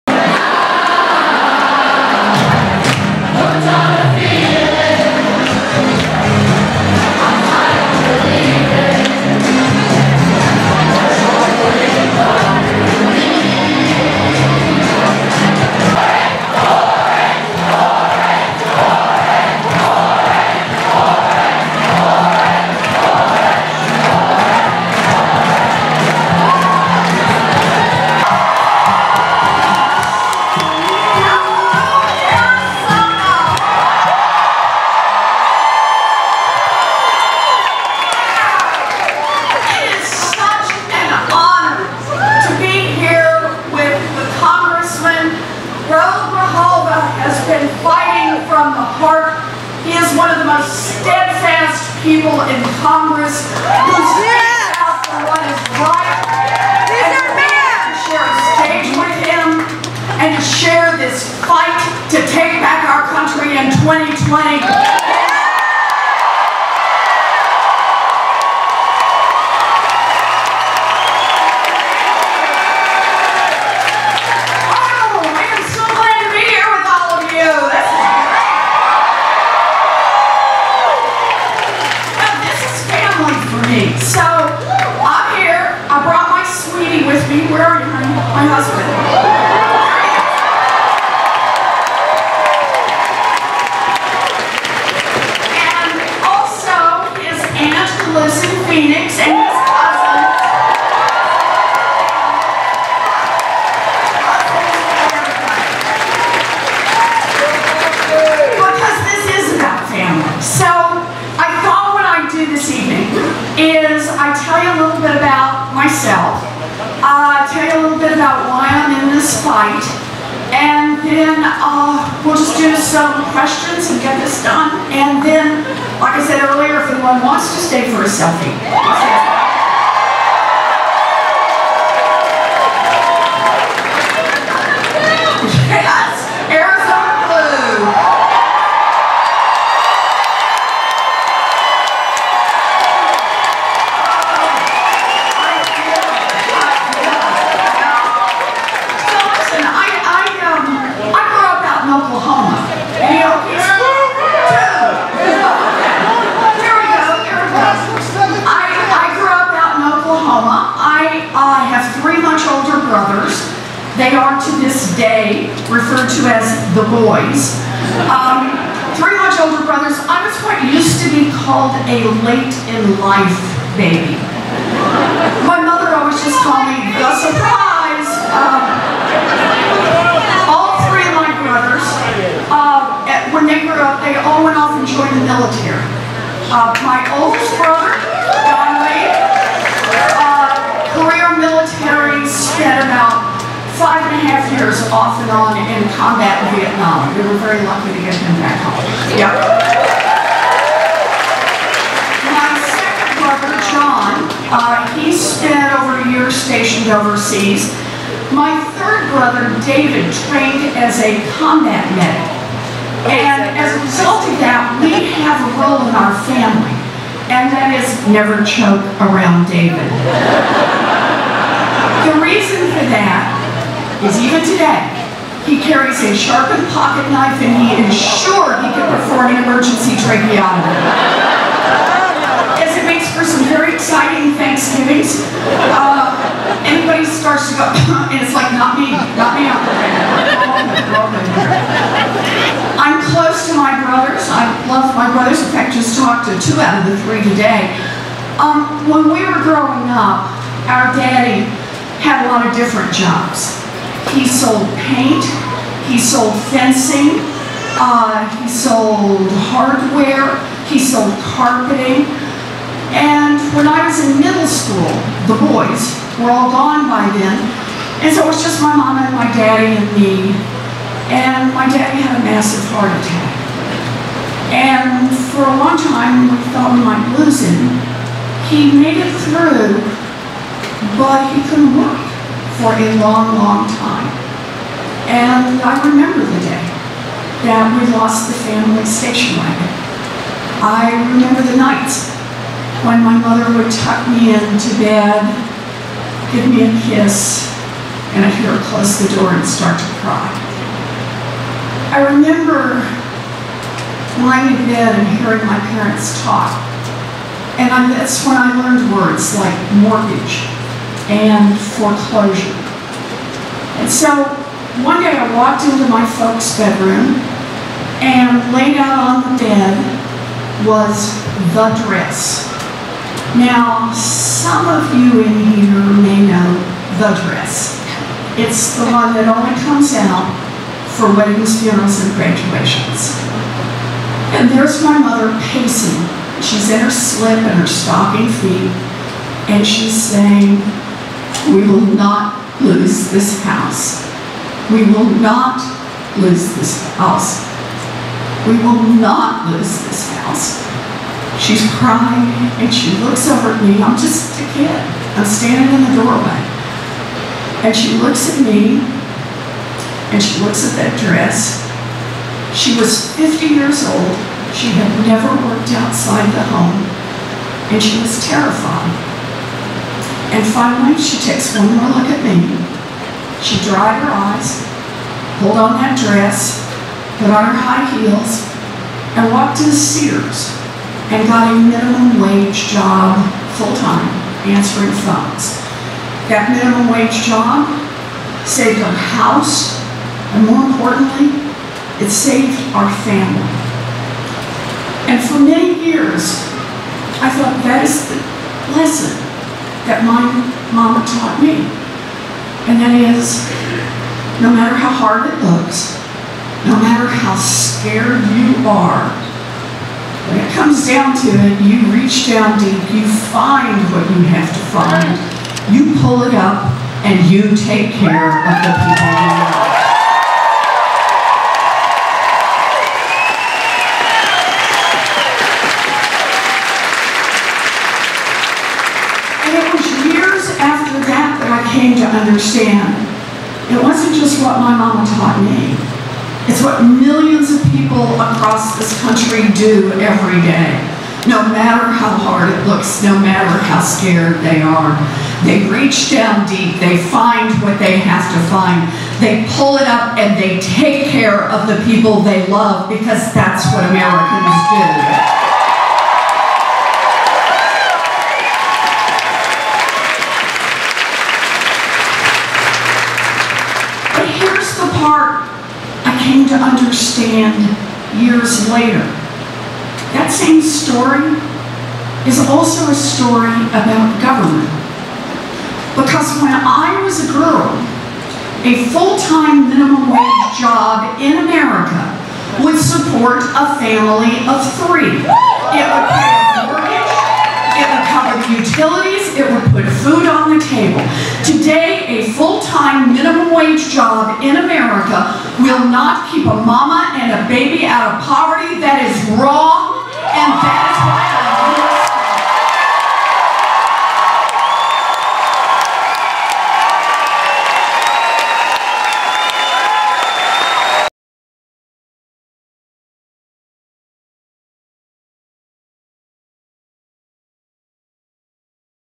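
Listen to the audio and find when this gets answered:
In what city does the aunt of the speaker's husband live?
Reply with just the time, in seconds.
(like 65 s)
98 s.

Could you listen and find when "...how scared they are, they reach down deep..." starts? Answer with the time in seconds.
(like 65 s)
443 s.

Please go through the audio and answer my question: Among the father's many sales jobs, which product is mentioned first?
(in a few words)
Paint.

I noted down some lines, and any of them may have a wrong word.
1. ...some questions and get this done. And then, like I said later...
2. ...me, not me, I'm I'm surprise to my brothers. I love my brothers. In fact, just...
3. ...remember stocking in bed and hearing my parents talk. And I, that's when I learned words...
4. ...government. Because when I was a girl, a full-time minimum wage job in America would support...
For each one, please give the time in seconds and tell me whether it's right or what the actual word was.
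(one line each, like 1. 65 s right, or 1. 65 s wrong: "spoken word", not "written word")
1. 122 s wrong: "earlier", not "later"
2. 238 s wrong: "close", not "surprise"
3. 302 s wrong: "lying", not "stocking"
4. 474 s right.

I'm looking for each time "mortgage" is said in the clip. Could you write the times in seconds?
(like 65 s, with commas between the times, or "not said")
309 s, 486 s.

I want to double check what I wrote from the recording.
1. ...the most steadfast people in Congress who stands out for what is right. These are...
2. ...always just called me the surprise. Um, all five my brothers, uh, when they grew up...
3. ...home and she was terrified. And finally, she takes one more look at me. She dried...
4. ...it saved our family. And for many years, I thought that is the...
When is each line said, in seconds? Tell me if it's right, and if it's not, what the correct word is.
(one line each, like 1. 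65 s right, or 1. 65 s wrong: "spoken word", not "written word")
1. 50 s right
2. 175 s wrong: "three", not "five"
3. 366 s right
4. 391 s right.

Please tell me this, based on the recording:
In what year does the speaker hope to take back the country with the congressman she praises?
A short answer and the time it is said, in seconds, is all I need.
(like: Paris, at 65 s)
2020, at 63 s.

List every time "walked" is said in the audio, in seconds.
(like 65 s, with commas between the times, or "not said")
315 s, 379 s.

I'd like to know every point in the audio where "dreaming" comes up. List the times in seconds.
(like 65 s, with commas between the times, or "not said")
not said.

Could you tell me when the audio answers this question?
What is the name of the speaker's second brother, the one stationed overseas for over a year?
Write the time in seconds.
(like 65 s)
203 s.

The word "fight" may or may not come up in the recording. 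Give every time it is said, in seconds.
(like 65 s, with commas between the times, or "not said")
61 s, 119 s.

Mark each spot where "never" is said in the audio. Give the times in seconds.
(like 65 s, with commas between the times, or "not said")
218 s, 365 s.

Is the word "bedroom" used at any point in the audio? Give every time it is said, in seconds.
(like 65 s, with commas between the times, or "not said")
316 s.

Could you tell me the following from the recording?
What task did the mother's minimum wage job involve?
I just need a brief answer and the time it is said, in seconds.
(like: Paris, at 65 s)
Answering phones, at 384 s.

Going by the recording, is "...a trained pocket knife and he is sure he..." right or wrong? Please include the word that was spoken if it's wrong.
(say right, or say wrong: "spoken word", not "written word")
wrong: "sharpened", not "trained".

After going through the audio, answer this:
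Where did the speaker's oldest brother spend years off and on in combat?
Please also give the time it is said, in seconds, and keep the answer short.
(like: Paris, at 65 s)
Vietnam, at 196 s.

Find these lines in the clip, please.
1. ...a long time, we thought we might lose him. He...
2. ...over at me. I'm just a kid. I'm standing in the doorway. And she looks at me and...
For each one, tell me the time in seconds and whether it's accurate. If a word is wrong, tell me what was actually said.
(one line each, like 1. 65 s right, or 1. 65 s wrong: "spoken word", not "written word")
1. 275 s right
2. 353 s right.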